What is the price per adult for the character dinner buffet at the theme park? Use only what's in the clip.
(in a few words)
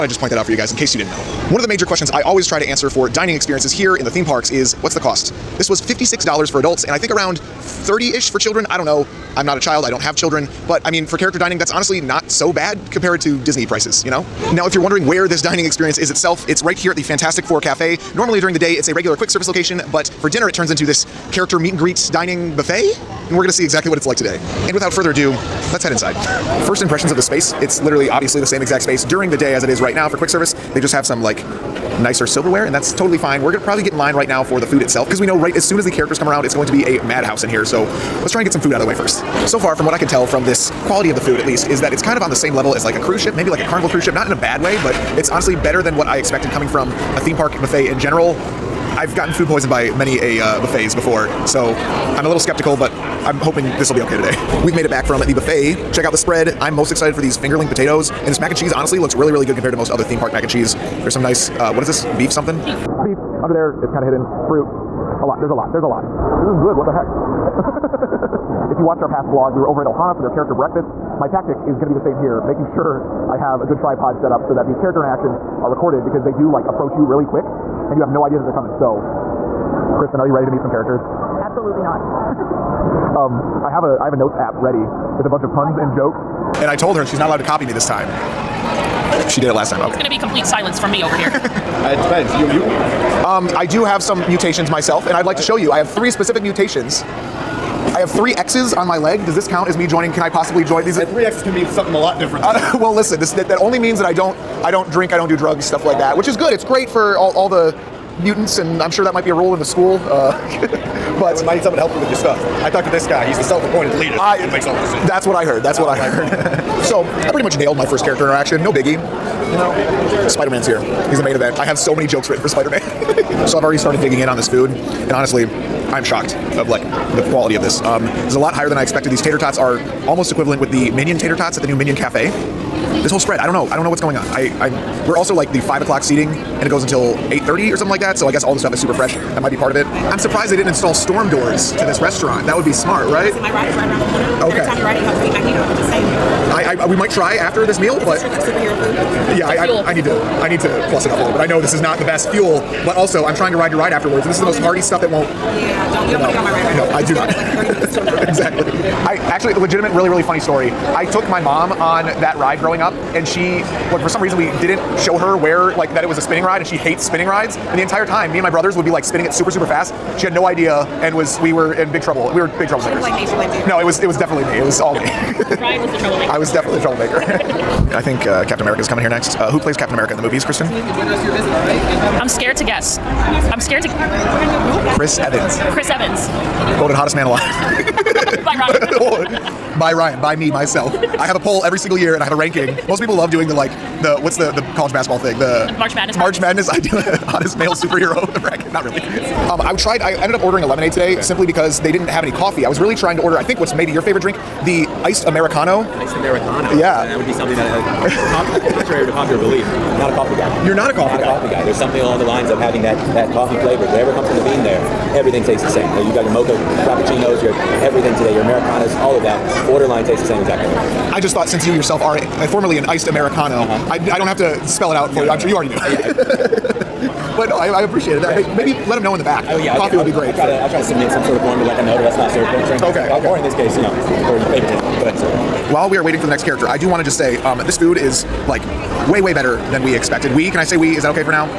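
$56.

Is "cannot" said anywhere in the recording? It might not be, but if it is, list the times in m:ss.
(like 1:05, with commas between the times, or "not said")
not said.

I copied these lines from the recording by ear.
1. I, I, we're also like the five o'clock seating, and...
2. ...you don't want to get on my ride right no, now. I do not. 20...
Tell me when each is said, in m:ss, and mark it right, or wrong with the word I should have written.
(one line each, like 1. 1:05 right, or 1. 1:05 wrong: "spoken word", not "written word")
1. 2:14 right
2. 2:36 wrong: "30", not "20".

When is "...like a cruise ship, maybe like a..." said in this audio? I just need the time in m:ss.
0:42.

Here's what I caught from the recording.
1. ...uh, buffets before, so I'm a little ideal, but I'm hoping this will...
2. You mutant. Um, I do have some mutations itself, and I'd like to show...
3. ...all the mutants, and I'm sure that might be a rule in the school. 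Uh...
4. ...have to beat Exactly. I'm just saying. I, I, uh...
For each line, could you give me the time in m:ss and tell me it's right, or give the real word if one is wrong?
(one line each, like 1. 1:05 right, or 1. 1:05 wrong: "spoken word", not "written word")
1. 0:50 wrong: "skeptical", not "ideal"
2. 1:32 wrong: "myself", not "itself"
3. 1:47 right
4. 2:25 wrong: "Magneto", not "Exactly".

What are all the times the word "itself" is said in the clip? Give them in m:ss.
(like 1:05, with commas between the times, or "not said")
0:16, 0:34.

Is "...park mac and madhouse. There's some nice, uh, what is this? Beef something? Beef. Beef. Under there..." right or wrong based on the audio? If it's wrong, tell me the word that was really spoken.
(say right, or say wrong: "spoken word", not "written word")
wrong: "cheese", not "madhouse".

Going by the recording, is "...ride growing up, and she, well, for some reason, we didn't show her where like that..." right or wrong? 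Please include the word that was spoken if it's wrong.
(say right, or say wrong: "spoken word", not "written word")
right.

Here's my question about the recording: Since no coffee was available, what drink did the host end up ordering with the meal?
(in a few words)
Lemonade.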